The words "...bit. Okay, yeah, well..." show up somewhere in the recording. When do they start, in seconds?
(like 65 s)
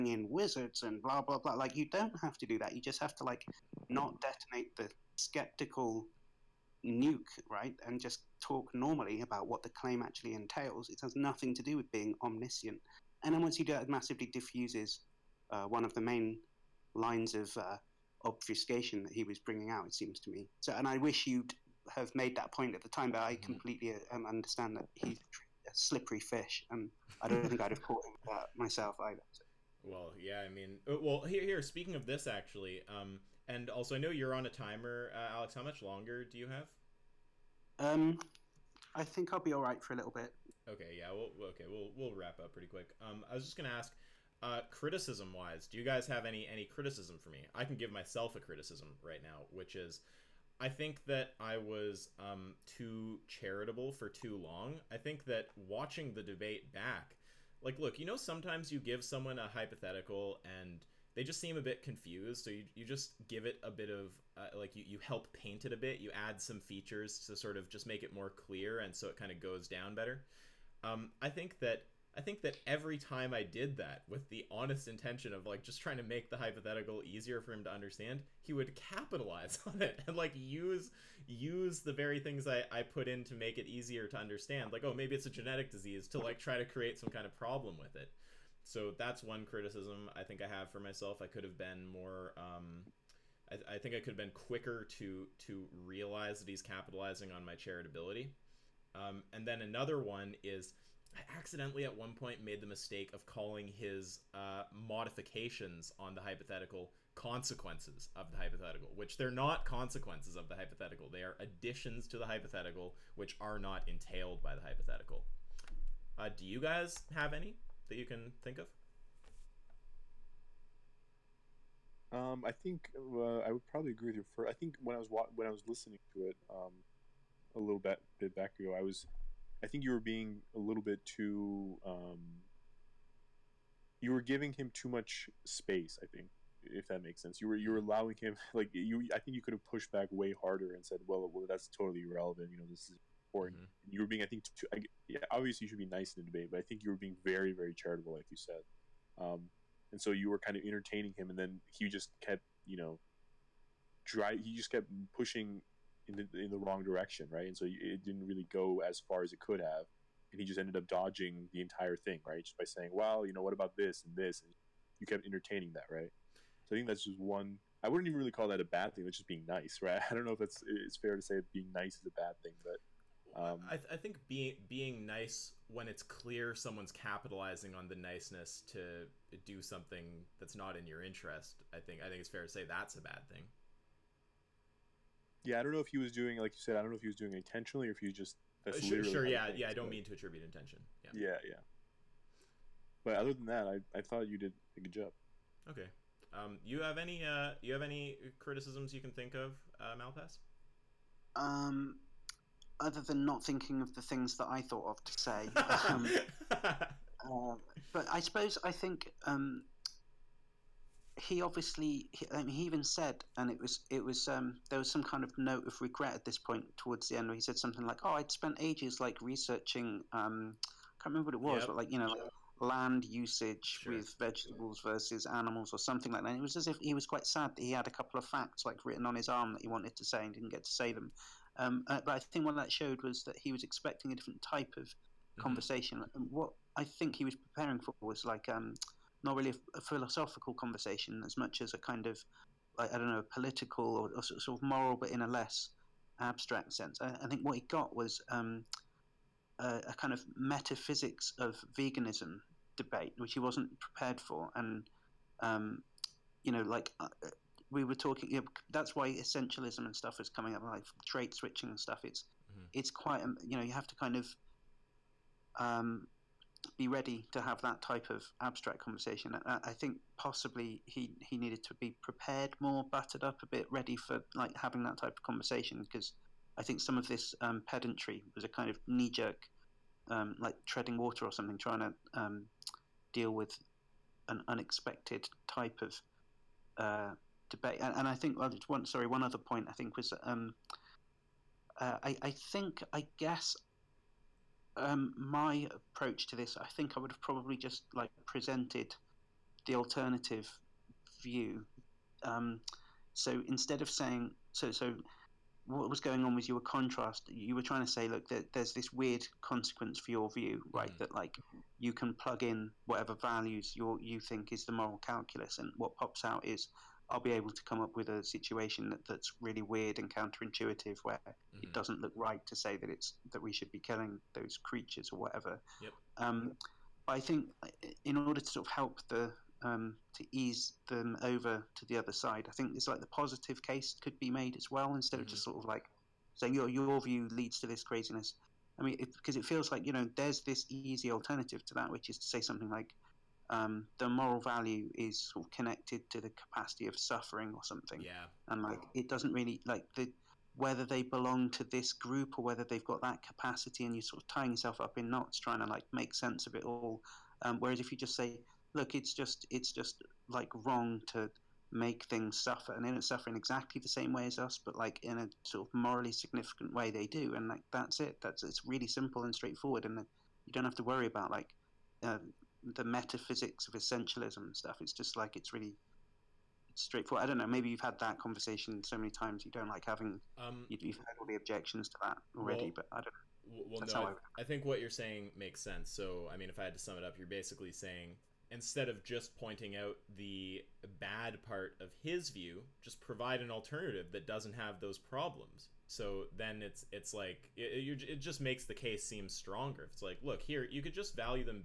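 40 s.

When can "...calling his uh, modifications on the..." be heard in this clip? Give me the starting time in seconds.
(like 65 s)
103 s.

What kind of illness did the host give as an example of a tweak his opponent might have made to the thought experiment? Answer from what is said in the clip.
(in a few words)
genetic disease.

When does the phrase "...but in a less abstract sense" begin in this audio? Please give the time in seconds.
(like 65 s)
244 s.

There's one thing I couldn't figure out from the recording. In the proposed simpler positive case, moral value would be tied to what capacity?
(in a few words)
capacity of suffering.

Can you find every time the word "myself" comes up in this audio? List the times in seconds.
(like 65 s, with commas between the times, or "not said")
28 s, 47 s, 90 s.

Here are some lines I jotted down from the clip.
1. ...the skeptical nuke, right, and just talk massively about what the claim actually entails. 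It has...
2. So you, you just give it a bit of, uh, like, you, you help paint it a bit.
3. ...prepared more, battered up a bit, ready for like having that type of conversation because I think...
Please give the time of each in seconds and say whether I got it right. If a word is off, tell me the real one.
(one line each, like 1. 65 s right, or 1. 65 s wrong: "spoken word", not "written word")
1. 4 s wrong: "normally", not "massively"
2. 62 s right
3. 271 s right.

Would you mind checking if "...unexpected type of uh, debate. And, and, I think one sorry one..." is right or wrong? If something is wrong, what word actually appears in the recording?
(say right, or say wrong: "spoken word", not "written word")
right.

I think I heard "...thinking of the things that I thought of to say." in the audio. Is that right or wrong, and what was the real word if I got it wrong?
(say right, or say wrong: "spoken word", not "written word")
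right.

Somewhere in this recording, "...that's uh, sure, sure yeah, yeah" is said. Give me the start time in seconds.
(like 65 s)
188 s.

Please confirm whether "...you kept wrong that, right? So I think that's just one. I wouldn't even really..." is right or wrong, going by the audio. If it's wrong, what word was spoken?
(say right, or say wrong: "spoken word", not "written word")
wrong: "entertaining", not "wrong".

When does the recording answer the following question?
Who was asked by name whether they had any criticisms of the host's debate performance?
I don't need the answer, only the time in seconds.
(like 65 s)
199 s.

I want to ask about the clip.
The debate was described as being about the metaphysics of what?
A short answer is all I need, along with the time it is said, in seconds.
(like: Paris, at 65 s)
veganism, at 251 s.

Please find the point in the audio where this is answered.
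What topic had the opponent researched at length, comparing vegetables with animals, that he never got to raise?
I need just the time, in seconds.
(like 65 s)
222 s.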